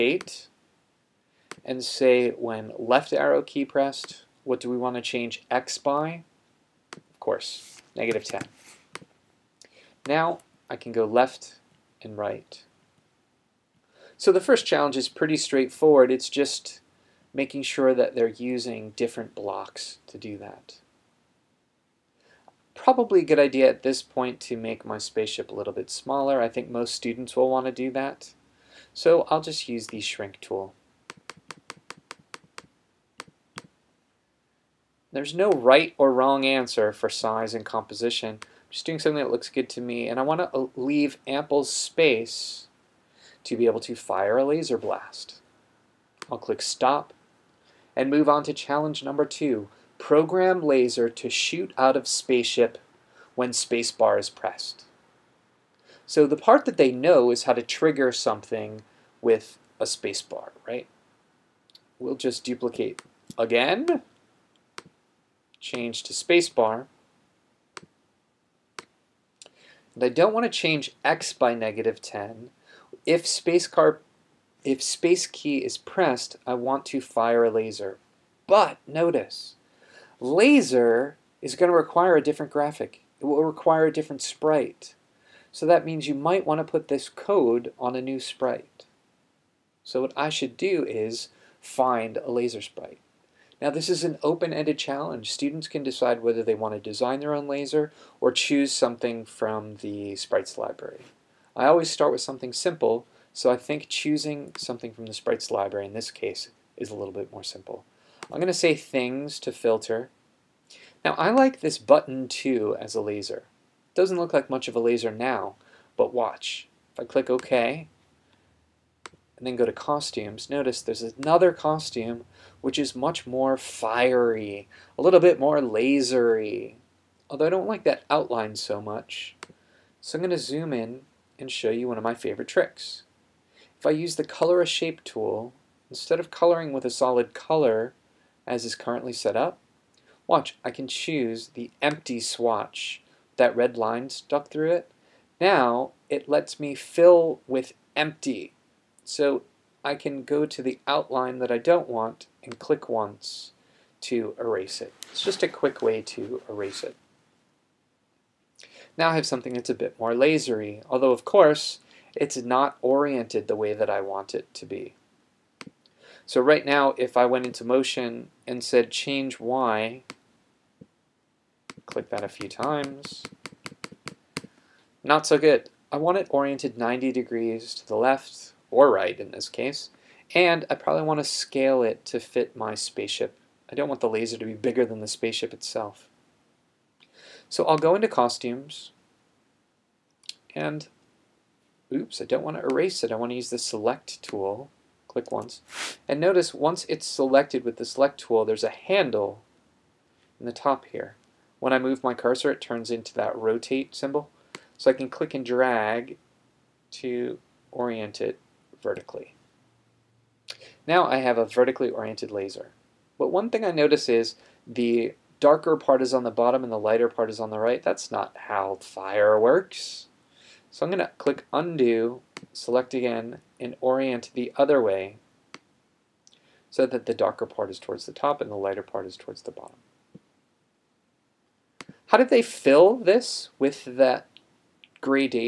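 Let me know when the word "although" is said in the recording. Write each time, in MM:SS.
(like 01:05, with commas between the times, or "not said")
02:07, 02:40.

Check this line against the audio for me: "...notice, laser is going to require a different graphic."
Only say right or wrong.
right.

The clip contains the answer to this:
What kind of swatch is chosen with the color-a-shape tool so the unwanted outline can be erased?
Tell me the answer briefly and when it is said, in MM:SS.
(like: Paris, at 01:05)
empty swatch, at 02:21.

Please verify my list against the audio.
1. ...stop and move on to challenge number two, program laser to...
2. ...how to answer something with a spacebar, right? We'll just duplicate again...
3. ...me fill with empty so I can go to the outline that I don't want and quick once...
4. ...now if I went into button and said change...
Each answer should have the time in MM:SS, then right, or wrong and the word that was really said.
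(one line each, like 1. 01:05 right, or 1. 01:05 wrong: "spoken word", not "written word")
1. 00:46 right
2. 00:57 wrong: "trigger", not "answer"
3. 02:26 wrong: "click", not "quick"
4. 02:46 wrong: "motion", not "button".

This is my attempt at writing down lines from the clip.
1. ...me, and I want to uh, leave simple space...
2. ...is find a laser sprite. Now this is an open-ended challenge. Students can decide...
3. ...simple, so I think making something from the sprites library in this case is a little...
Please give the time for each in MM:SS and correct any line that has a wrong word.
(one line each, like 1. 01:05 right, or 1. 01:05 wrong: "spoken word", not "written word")
1. 00:39 wrong: "ample", not "simple"
2. 01:30 right
3. 01:42 wrong: "choosing", not "making".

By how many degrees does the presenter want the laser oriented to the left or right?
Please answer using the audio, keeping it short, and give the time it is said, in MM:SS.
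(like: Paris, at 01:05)
90, at 02:56.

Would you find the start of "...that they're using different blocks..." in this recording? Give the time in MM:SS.
00:17.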